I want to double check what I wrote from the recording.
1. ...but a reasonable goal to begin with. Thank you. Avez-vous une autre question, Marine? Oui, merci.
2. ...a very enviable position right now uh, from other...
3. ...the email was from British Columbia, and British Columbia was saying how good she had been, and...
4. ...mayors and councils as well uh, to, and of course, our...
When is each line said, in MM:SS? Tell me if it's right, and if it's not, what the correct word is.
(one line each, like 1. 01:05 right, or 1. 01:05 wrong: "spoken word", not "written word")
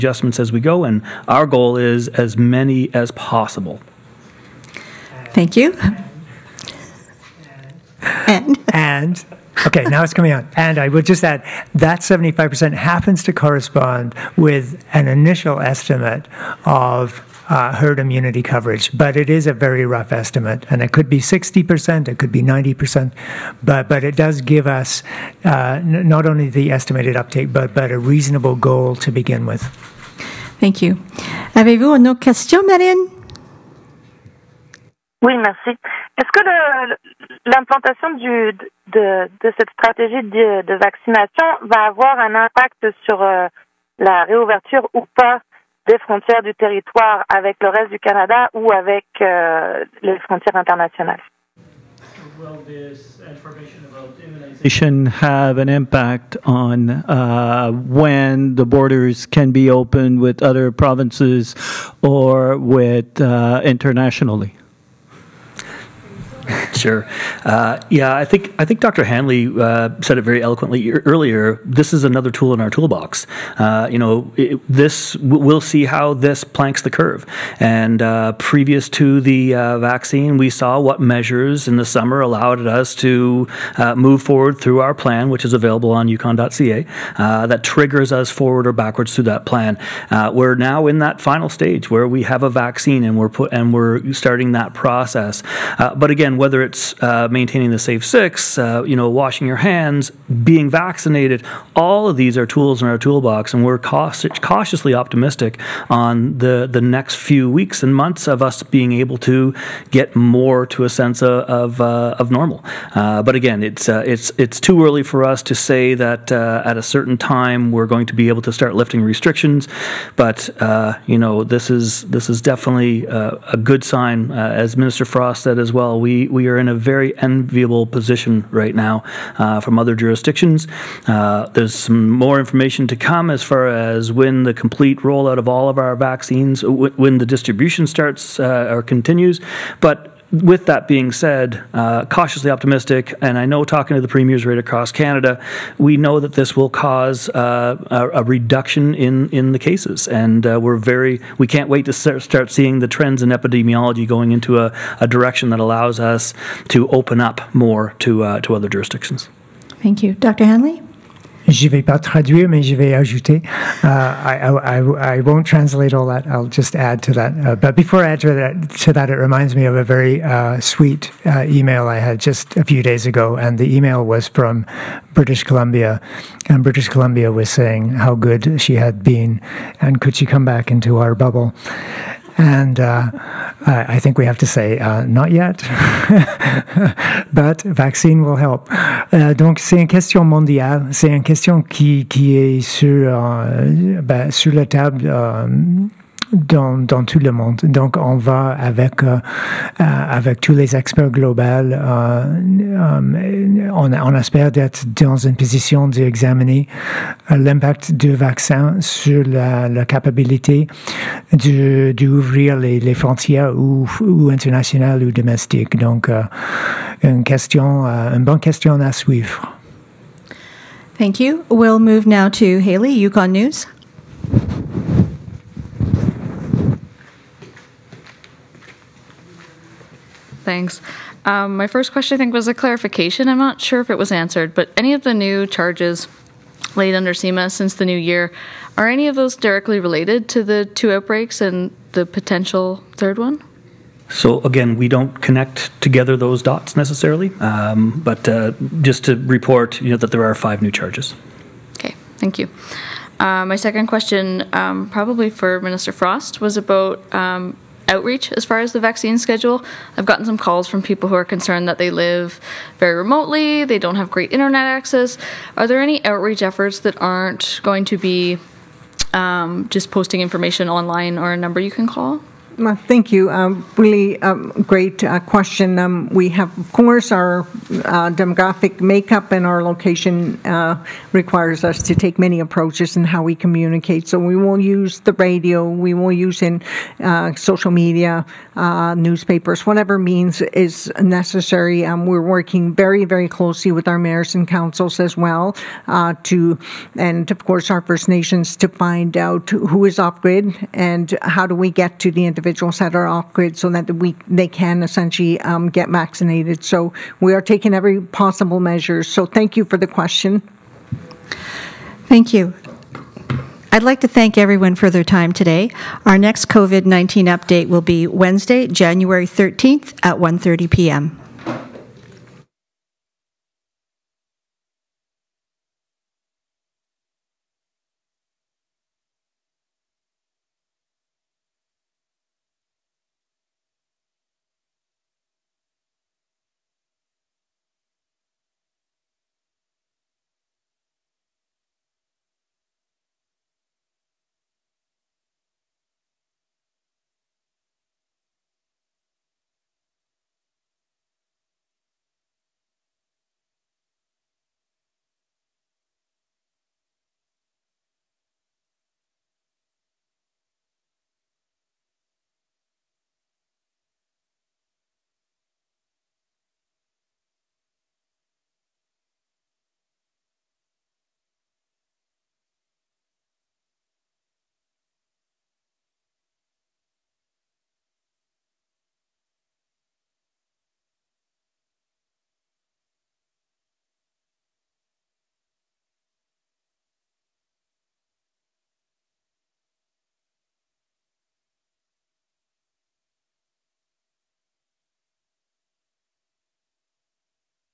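1. 00:27 right
2. 02:06 right
3. 02:53 right
4. 04:53 right.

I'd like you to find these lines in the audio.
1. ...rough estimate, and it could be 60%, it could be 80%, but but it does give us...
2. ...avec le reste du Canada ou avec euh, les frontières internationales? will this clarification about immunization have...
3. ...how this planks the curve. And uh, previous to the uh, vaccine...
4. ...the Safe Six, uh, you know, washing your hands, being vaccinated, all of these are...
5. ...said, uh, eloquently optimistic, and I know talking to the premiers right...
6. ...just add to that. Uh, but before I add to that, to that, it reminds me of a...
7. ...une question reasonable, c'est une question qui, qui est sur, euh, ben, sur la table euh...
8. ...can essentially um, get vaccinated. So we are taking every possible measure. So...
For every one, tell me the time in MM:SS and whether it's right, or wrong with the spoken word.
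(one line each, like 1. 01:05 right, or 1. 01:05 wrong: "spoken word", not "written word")
1. 00:19 wrong: "90", not "80"
2. 00:47 wrong: "information", not "clarification"
3. 01:15 right
4. 01:37 right
5. 02:21 wrong: "cautiously", not "eloquently"
6. 02:46 right
7. 03:09 wrong: "mondiale", not "reasonable"
8. 05:04 right.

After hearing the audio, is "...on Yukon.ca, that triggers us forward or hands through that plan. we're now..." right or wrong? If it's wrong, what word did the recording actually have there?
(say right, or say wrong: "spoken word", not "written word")
wrong: "backwards", not "hands".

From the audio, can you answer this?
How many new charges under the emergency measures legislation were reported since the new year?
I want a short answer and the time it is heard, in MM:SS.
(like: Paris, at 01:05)
5, at 04:10.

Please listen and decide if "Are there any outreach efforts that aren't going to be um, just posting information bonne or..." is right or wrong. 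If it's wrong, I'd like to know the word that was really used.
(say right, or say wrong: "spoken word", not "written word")
wrong: "online", not "bonne".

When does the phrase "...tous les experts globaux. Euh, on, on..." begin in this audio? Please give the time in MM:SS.
03:20.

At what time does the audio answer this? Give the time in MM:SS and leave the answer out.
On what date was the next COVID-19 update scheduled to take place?
05:18.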